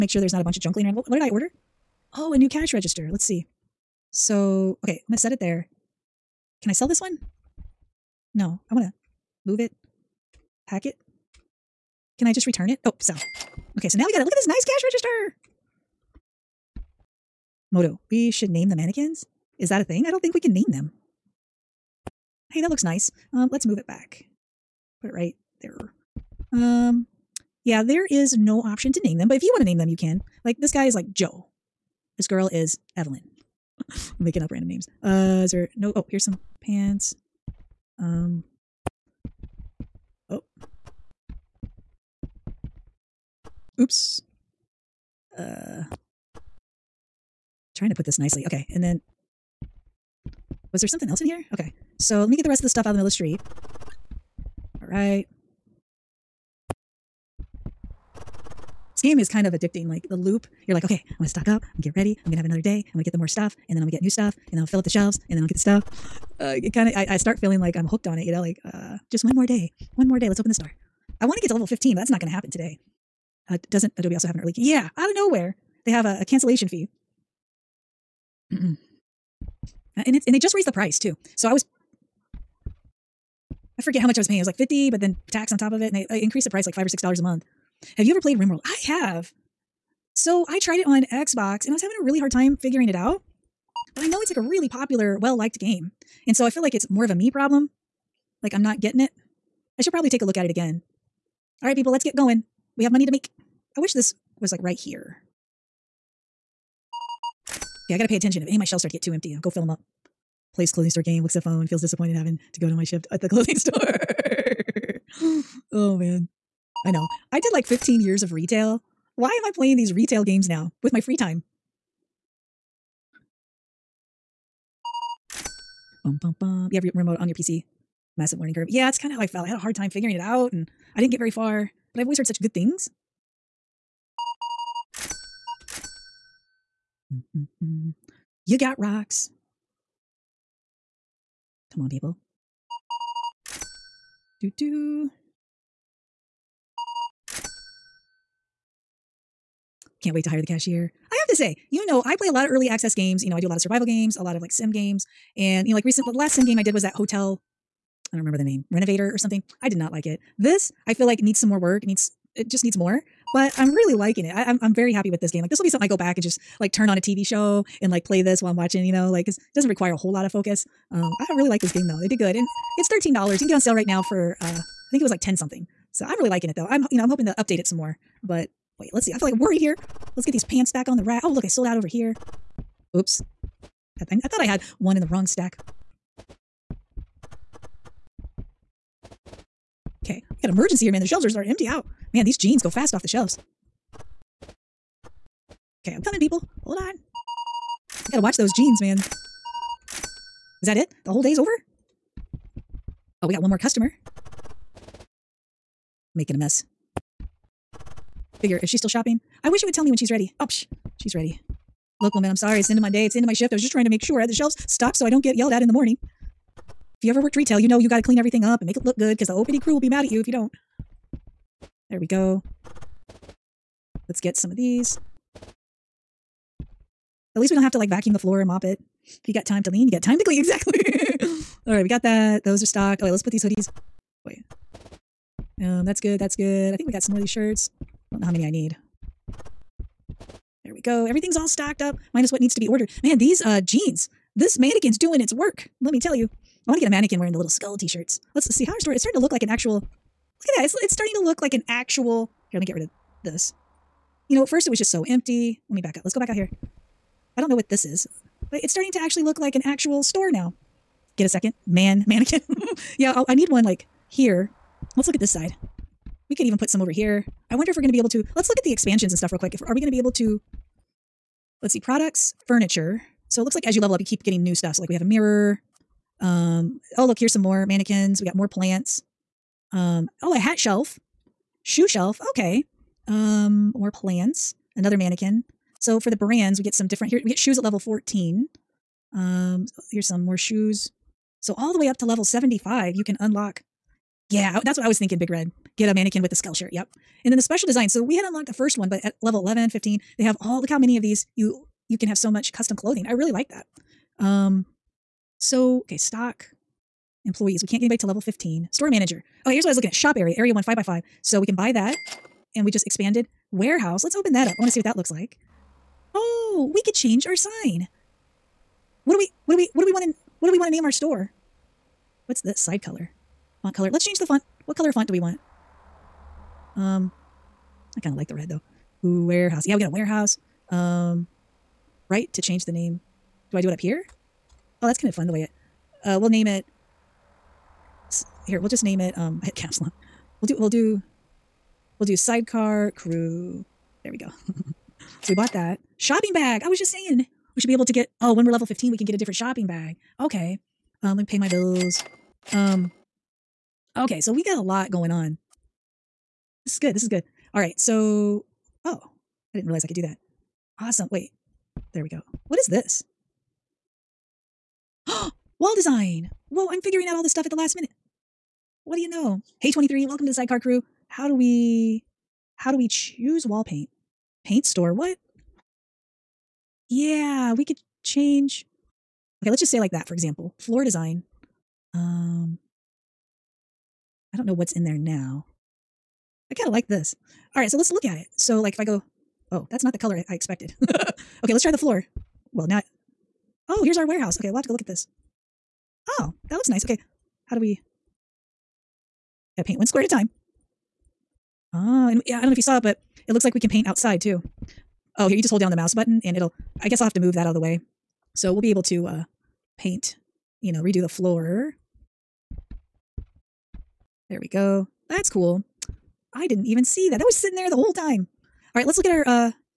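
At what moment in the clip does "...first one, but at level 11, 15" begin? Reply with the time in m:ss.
4:58.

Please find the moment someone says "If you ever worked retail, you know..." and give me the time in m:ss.
3:36.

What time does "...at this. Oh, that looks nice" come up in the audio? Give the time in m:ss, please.
6:34.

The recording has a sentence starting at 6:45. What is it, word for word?
Oh, here, you just hold down the mouse button and it'll, I guess I'll have to move that out of the way.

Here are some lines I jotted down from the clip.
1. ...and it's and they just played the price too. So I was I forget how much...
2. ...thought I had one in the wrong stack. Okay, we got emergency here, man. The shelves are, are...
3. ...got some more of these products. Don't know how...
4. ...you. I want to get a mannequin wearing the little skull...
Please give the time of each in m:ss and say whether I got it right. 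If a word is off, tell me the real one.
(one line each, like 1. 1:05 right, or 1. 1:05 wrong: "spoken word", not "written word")
1. 1:20 wrong: "raised", not "played"
2. 3:04 right
3. 3:56 wrong: "shirts", not "products"
4. 4:06 right.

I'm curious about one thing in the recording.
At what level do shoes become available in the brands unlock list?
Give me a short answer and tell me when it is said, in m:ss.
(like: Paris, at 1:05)
14, at 4:47.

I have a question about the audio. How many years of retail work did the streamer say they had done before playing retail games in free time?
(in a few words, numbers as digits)
15.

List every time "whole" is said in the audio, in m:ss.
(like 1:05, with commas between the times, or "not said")
2:49, 3:21, 6:57.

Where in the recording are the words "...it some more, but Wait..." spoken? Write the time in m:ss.
2:57.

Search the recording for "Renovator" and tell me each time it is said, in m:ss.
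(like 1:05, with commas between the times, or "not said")
2:38.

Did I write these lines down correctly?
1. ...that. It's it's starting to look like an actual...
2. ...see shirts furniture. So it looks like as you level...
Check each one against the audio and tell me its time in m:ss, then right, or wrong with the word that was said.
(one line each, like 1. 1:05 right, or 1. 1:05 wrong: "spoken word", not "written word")
1. 4:10 right
2. 4:31 wrong: "products", not "shirts".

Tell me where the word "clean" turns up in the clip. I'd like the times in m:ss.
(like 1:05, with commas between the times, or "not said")
3:38, 3:50.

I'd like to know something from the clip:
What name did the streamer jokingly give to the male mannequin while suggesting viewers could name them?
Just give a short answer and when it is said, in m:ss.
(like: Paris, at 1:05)
Joe, at 0:31.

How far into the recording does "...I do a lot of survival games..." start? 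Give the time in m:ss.
2:33.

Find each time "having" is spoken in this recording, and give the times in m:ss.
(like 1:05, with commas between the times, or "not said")
1:31, 1:52.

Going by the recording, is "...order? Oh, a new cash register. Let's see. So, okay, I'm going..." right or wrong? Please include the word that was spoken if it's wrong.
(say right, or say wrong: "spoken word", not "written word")
right.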